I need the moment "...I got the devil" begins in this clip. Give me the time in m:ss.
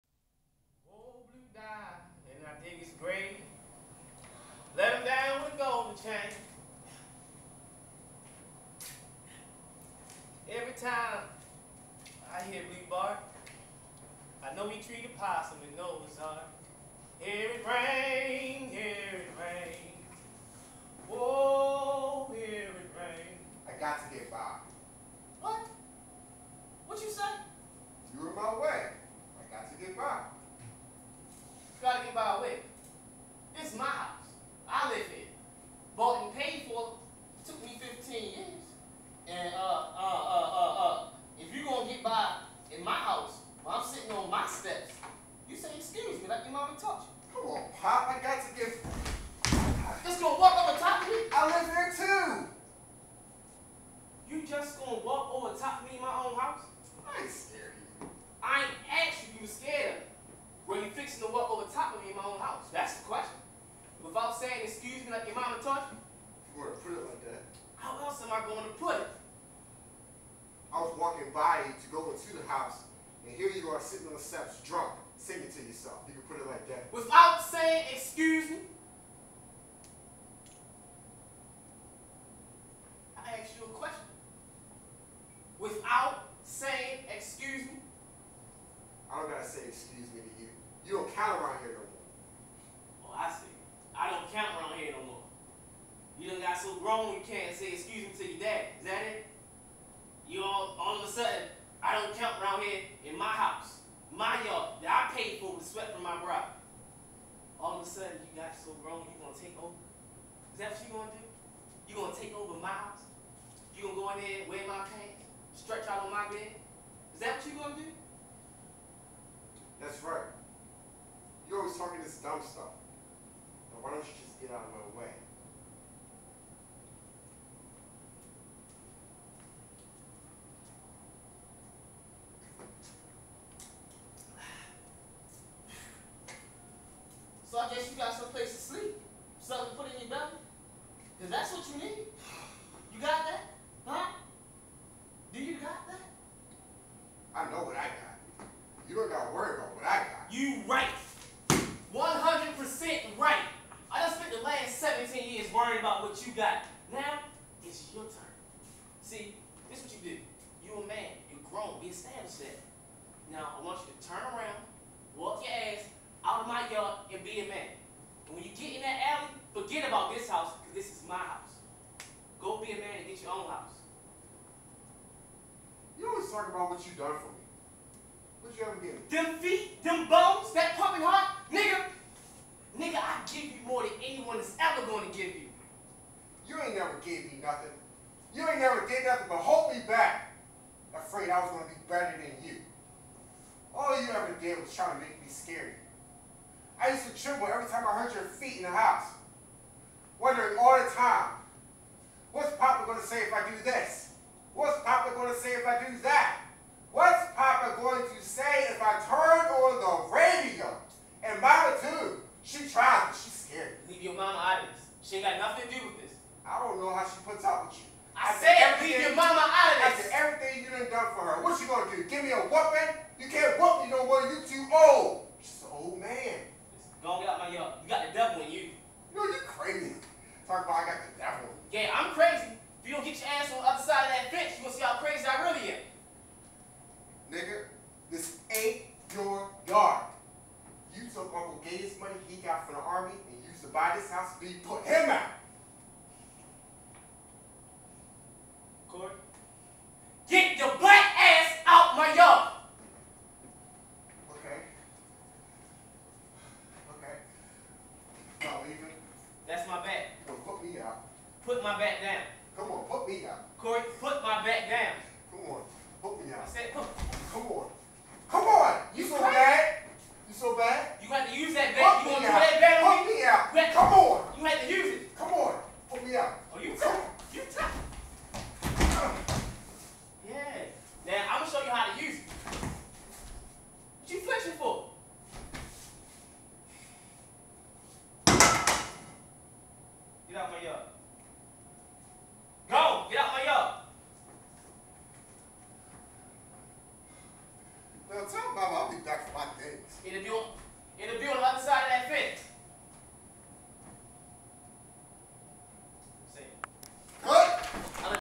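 3:50.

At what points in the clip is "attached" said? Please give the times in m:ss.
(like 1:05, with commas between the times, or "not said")
not said.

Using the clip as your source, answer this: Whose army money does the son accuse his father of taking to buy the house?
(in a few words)
Uncle Gabe.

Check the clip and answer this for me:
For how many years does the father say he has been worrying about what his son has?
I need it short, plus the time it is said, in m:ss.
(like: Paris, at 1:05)
17, at 2:34.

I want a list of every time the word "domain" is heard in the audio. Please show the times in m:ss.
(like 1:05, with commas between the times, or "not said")
not said.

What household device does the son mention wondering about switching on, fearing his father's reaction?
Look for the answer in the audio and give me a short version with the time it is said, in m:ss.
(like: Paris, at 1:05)
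radio, at 3:30.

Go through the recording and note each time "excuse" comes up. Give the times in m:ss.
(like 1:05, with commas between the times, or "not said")
1:17, 1:37.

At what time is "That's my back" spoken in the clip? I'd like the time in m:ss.
4:19.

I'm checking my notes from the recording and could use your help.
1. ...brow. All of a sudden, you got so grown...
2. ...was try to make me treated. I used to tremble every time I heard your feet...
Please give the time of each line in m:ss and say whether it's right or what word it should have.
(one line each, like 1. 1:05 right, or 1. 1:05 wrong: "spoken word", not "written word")
1. 1:46 right
2. 3:14 wrong: "scared", not "treated".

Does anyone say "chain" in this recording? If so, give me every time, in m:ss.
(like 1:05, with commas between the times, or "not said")
0:05.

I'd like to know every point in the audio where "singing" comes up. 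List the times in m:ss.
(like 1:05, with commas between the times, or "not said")
1:15.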